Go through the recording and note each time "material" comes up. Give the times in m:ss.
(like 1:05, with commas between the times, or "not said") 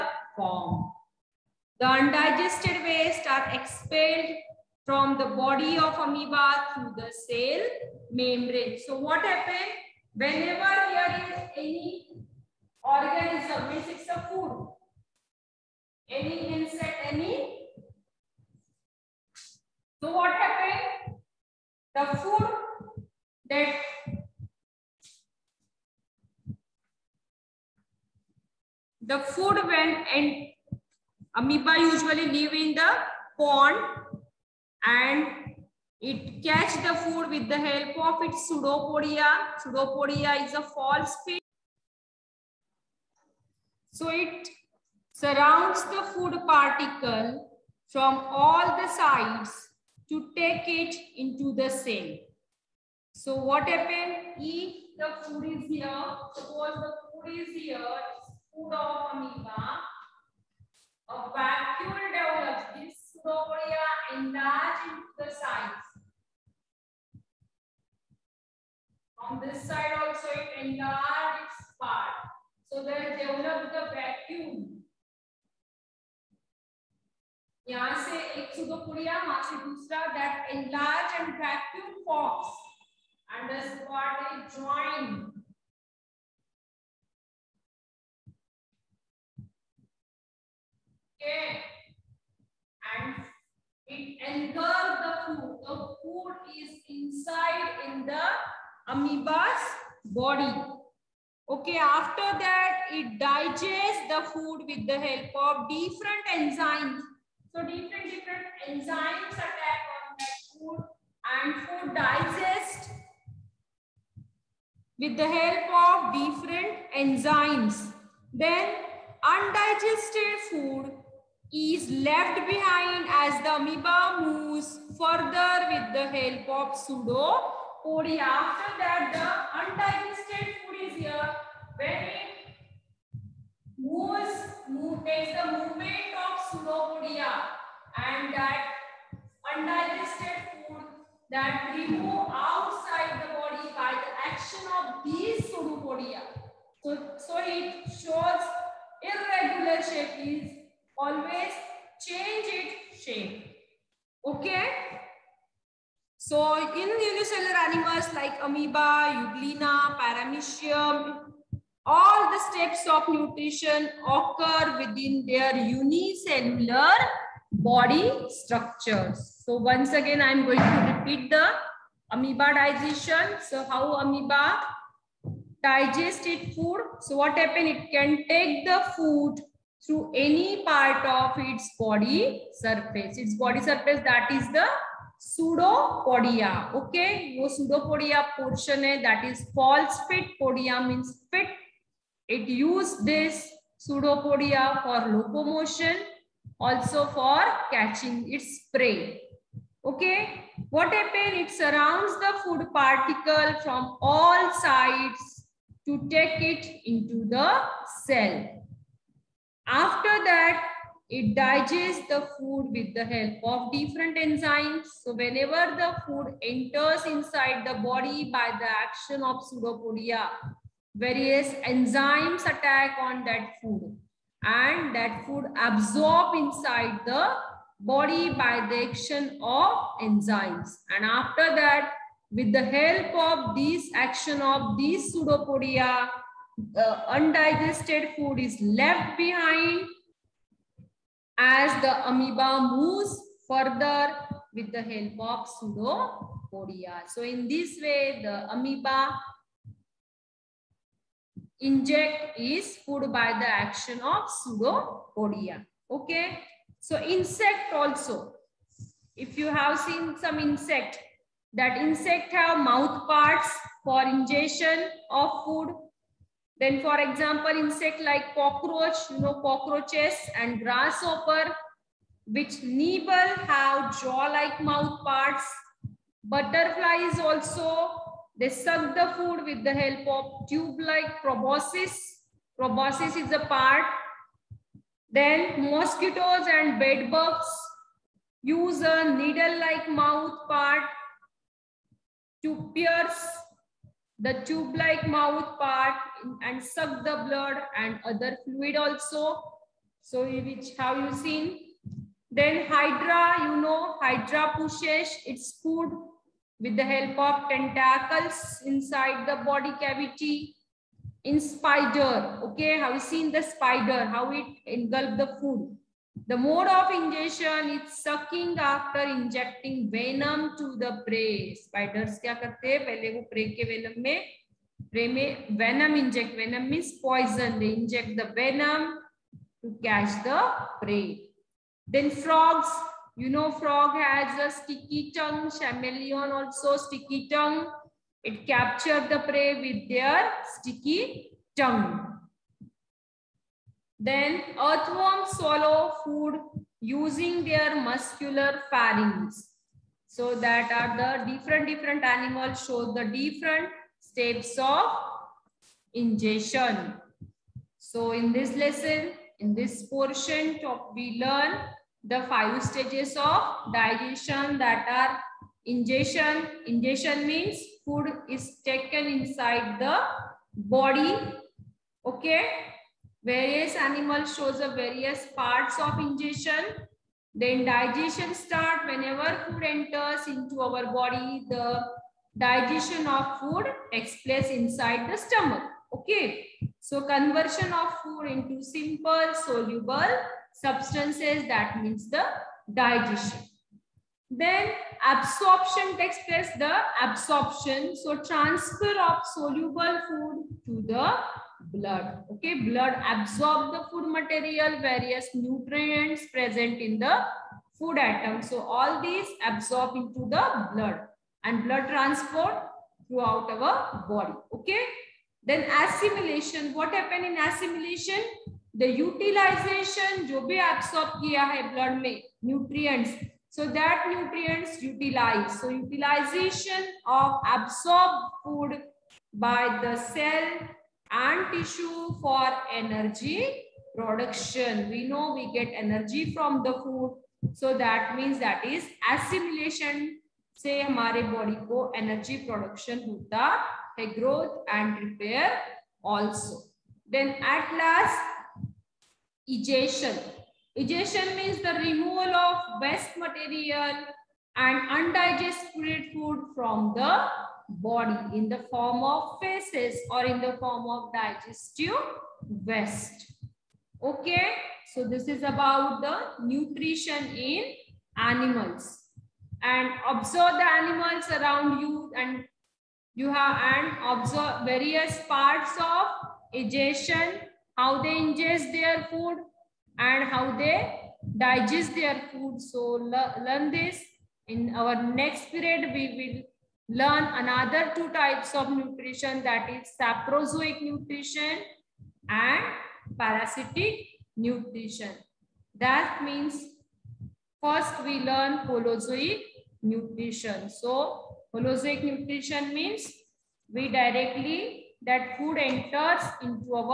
6:44, 7:33.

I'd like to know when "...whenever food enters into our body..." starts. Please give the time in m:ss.
6:18.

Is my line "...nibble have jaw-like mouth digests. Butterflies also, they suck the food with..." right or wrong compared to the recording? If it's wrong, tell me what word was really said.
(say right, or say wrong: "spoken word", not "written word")
wrong: "parts", not "digests".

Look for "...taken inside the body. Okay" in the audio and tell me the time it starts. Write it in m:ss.
6:08.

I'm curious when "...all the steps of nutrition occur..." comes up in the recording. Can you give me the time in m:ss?
2:41.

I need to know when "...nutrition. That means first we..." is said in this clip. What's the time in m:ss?
8:14.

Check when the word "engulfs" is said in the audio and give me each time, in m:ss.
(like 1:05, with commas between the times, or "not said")
1:34, 5:14.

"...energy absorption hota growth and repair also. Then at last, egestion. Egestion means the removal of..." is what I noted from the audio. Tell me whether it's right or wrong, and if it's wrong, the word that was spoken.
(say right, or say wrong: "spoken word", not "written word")
wrong: "production", not "absorption".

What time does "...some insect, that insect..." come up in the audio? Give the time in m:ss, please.
4:20.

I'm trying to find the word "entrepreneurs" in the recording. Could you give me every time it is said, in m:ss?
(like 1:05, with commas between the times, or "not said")
not said.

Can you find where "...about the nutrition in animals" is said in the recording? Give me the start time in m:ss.
7:45.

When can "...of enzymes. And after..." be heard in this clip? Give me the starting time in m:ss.
3:49.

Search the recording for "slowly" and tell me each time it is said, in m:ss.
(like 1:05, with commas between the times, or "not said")
not said.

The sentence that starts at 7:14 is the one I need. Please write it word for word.
We know we get energy from the food.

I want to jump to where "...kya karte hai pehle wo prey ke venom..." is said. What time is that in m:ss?
5:22.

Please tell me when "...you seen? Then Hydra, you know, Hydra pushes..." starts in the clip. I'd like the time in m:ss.
5:00.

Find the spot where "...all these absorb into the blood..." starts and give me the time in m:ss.
6:48.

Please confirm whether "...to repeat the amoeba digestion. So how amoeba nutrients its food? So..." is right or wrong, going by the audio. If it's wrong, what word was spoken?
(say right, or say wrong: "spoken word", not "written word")
wrong: "digests", not "nutrients".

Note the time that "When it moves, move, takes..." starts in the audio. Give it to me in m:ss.
2:11.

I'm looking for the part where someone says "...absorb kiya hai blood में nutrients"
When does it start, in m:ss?
7:00.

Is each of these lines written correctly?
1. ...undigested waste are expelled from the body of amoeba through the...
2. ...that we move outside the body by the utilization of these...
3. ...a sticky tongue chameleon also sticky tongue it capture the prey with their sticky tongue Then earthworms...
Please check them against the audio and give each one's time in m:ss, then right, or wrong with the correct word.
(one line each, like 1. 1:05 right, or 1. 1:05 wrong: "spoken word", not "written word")
1. 0:01 right
2. 2:21 wrong: "action", not "utilization"
3. 5:34 right.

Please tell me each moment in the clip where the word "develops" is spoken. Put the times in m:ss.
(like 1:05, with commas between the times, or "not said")
1:02, 1:13.